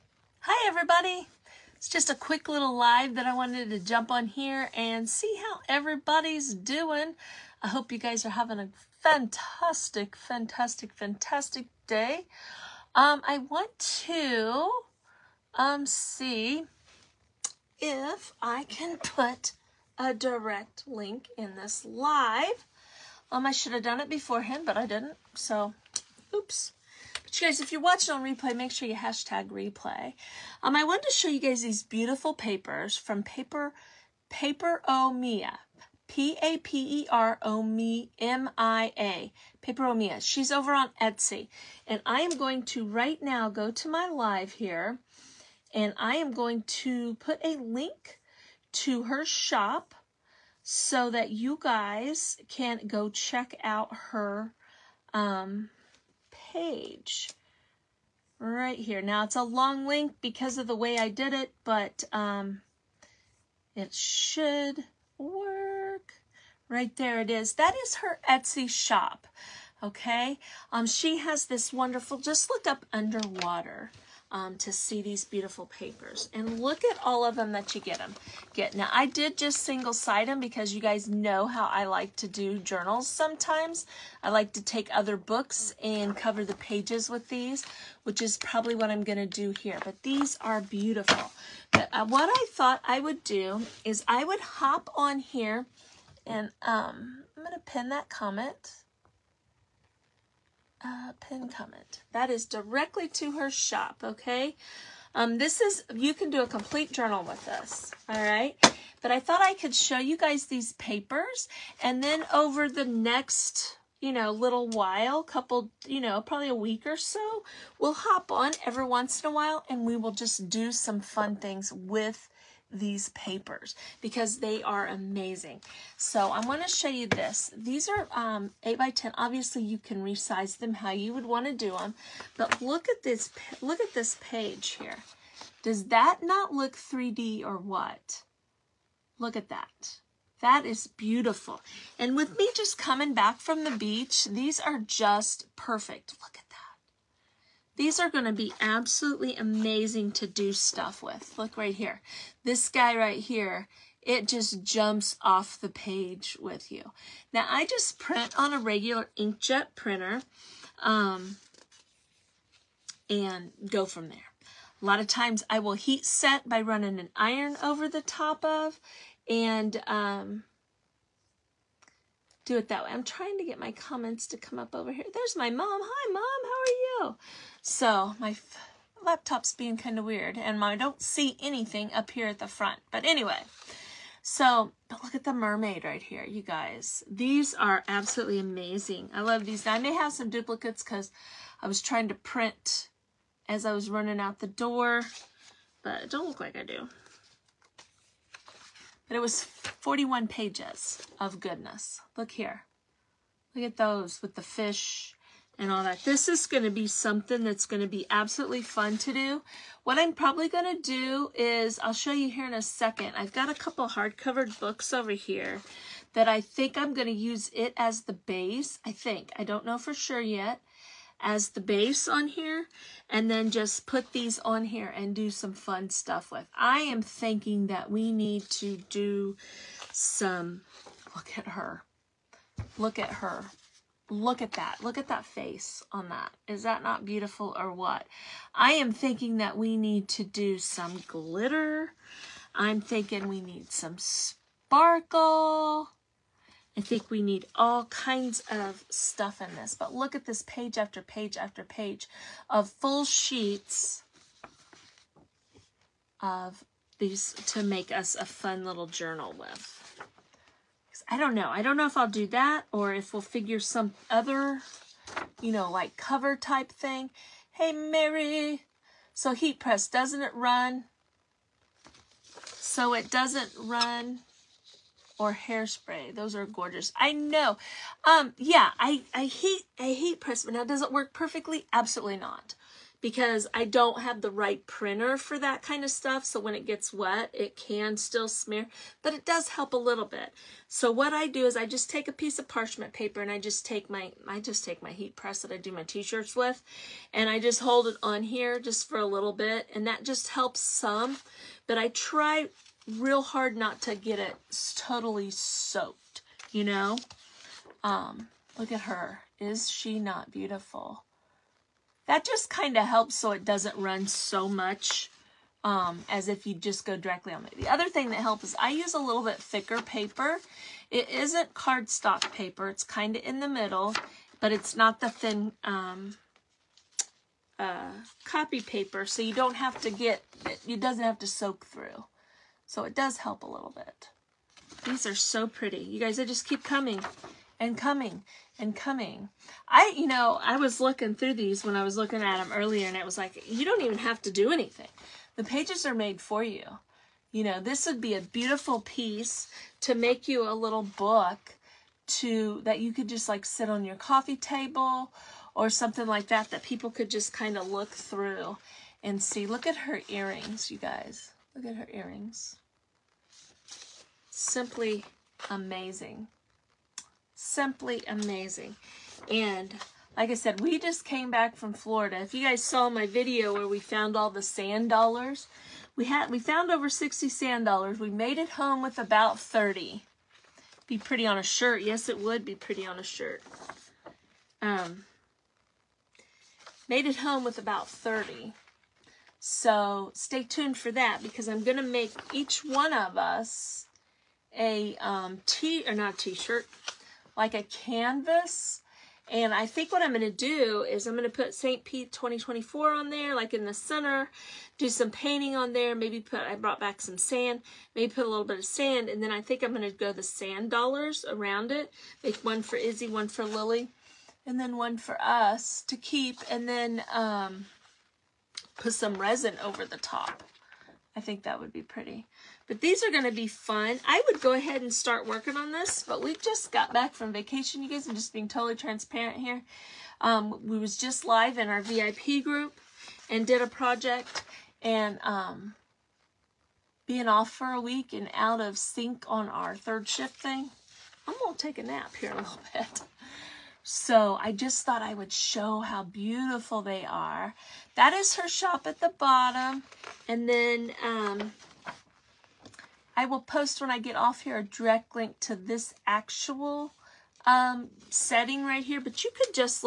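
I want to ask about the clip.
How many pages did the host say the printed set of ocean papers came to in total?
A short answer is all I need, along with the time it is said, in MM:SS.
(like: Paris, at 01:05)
41, at 03:19.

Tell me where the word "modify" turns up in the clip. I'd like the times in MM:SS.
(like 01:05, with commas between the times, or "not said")
not said.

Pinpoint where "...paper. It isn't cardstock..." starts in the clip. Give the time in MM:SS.
05:19.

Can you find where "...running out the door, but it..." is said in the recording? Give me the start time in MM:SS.
03:13.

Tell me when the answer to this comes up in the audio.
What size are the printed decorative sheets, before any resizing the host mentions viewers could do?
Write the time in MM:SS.
02:08.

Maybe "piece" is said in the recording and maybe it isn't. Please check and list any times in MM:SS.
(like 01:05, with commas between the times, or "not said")
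04:52, 05:48.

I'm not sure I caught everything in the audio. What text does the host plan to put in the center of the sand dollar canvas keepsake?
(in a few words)
St. Pete 2024.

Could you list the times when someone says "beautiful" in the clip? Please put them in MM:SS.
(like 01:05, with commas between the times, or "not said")
00:31, 01:15, 01:30, 02:20, 03:57, 05:10, 05:48, 07:26.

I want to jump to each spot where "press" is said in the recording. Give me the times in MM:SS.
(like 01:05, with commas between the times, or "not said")
04:29, 04:40, 04:55.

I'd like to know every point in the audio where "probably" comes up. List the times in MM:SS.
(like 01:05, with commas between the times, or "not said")
01:28, 01:56, 03:30.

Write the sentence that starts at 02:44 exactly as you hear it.
A lot of times I will heat set by running an iron over the top of and um, do it that way.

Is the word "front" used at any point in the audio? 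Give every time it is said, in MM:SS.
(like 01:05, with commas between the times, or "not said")
03:02.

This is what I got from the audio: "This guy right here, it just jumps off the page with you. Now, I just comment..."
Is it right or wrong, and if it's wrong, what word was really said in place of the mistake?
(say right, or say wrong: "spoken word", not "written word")
wrong: "print", not "comment".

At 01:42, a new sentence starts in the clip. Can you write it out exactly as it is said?
That is directly to her shop, okay?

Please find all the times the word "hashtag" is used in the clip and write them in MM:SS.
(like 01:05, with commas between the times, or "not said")
00:28.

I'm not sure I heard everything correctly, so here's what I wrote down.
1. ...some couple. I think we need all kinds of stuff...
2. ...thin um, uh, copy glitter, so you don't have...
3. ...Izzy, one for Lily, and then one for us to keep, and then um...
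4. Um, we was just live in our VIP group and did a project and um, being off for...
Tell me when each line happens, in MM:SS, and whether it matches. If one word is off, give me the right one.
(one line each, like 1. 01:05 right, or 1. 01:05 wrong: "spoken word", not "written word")
1. 04:03 wrong: "sparkle", not "couple"
2. 05:25 wrong: "paper", not "glitter"
3. 06:52 right
4. 07:10 right.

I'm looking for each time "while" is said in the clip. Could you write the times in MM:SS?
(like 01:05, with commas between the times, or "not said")
01:54, 01:59.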